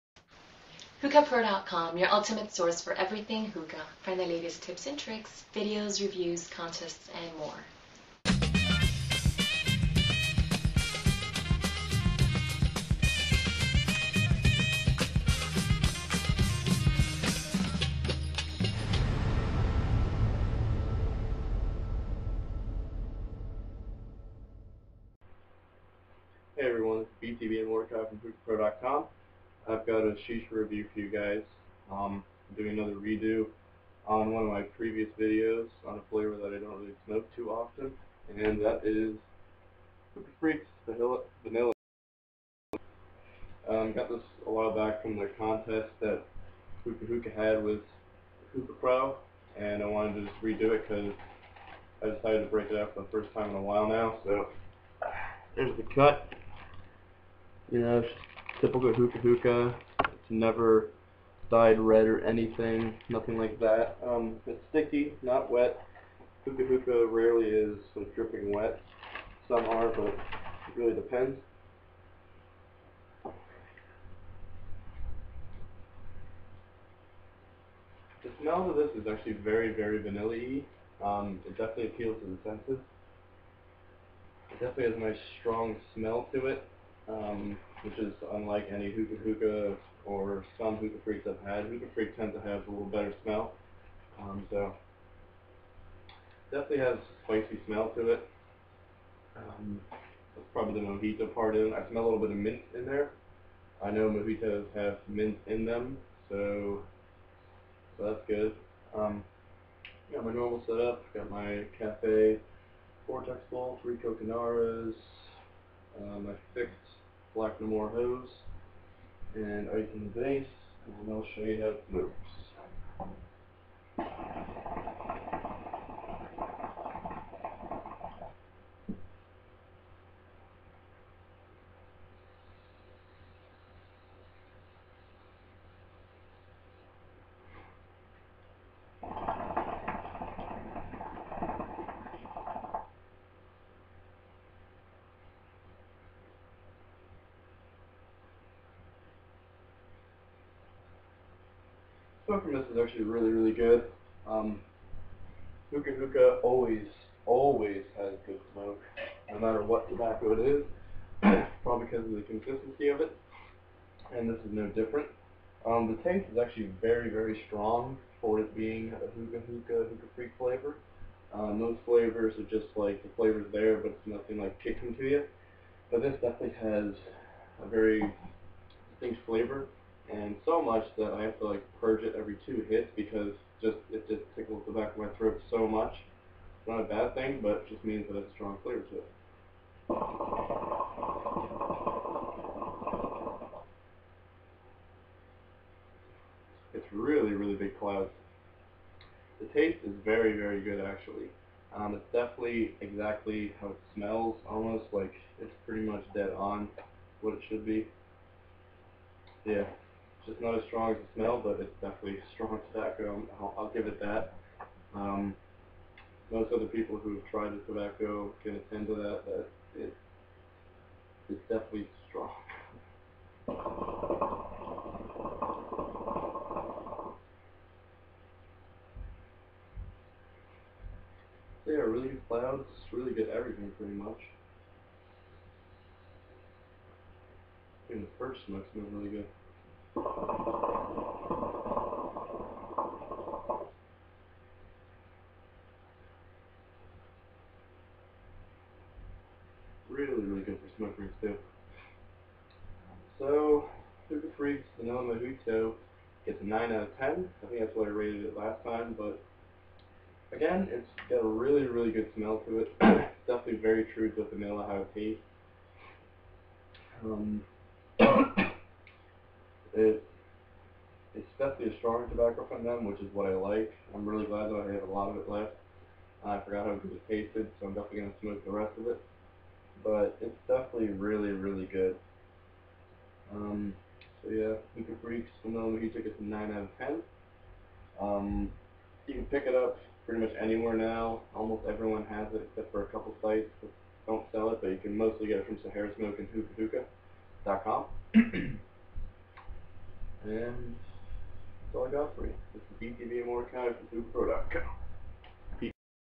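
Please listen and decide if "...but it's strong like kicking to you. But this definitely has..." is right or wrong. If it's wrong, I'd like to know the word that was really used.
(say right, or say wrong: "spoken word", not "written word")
wrong: "nothing", not "strong".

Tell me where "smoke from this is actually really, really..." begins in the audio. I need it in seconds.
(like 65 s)
152 s.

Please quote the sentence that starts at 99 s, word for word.
Um, that's probably the mojito part in.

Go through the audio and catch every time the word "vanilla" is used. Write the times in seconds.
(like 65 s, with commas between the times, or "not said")
40 s, 80 s, 264 s.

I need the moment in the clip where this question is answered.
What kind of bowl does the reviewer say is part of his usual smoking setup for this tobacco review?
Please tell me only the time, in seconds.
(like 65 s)
111 s.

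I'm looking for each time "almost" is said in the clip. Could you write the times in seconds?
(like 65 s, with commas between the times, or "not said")
204 s, 291 s.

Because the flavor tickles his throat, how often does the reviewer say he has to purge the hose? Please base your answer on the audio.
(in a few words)
Every 2 hits.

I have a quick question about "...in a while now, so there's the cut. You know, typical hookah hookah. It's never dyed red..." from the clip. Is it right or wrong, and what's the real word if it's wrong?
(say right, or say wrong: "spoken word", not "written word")
right.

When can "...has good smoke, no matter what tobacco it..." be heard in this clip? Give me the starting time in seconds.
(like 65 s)
157 s.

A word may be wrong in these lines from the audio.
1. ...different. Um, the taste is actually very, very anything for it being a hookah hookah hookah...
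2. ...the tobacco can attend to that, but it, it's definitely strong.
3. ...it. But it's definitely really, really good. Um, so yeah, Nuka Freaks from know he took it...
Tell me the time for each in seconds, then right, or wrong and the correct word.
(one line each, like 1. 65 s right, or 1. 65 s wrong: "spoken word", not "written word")
1. 164 s wrong: "strong", not "anything"
2. 217 s right
3. 278 s right.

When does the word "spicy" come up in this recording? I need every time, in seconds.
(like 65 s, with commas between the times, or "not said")
97 s.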